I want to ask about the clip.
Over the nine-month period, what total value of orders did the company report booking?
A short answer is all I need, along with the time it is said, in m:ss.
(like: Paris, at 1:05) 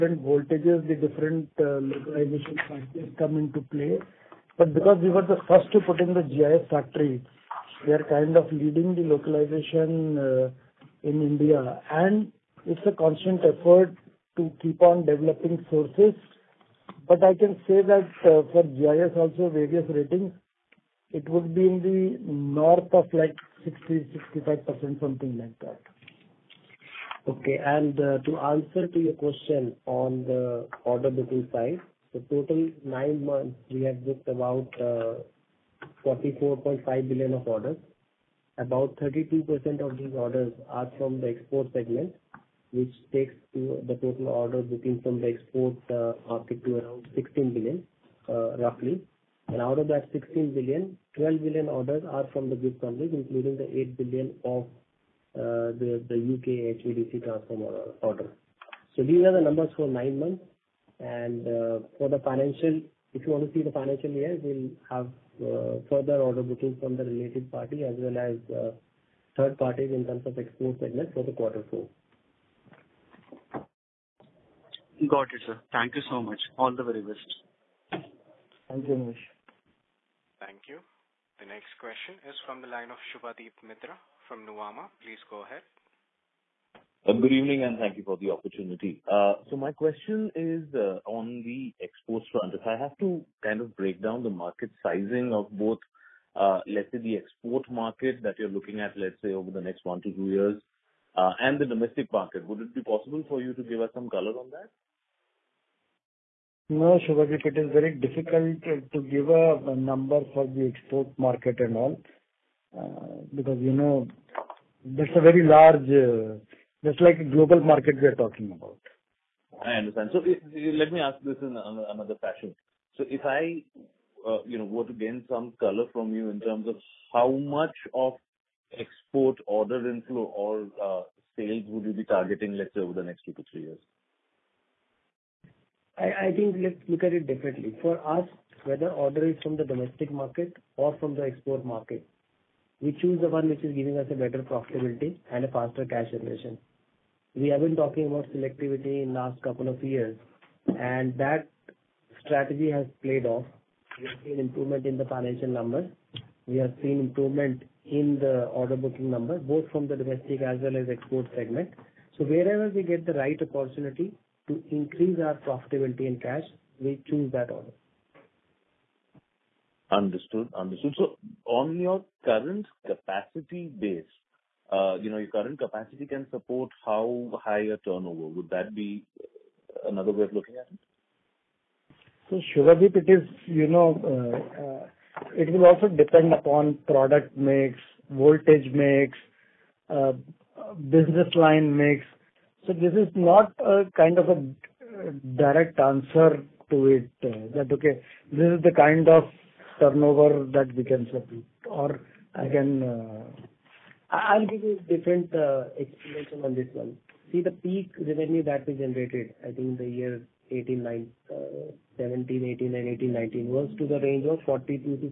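44.5 billion, at 0:36.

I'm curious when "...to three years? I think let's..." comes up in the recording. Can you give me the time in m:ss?
2:13.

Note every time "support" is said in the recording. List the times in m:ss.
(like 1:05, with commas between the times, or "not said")
2:56, 3:21.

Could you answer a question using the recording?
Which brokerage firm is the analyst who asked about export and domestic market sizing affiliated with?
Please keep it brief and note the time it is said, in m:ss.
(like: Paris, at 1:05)
Nuvama, at 1:24.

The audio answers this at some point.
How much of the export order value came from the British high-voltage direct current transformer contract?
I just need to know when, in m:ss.
0:53.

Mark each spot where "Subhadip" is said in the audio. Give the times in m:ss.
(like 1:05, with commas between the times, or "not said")
1:23, 1:47.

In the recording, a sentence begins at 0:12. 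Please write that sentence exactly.
It's a constant effort to keep on developing sources.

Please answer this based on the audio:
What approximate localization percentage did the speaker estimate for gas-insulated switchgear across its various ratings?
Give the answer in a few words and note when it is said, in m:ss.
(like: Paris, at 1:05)
60%-65%, at 0:23.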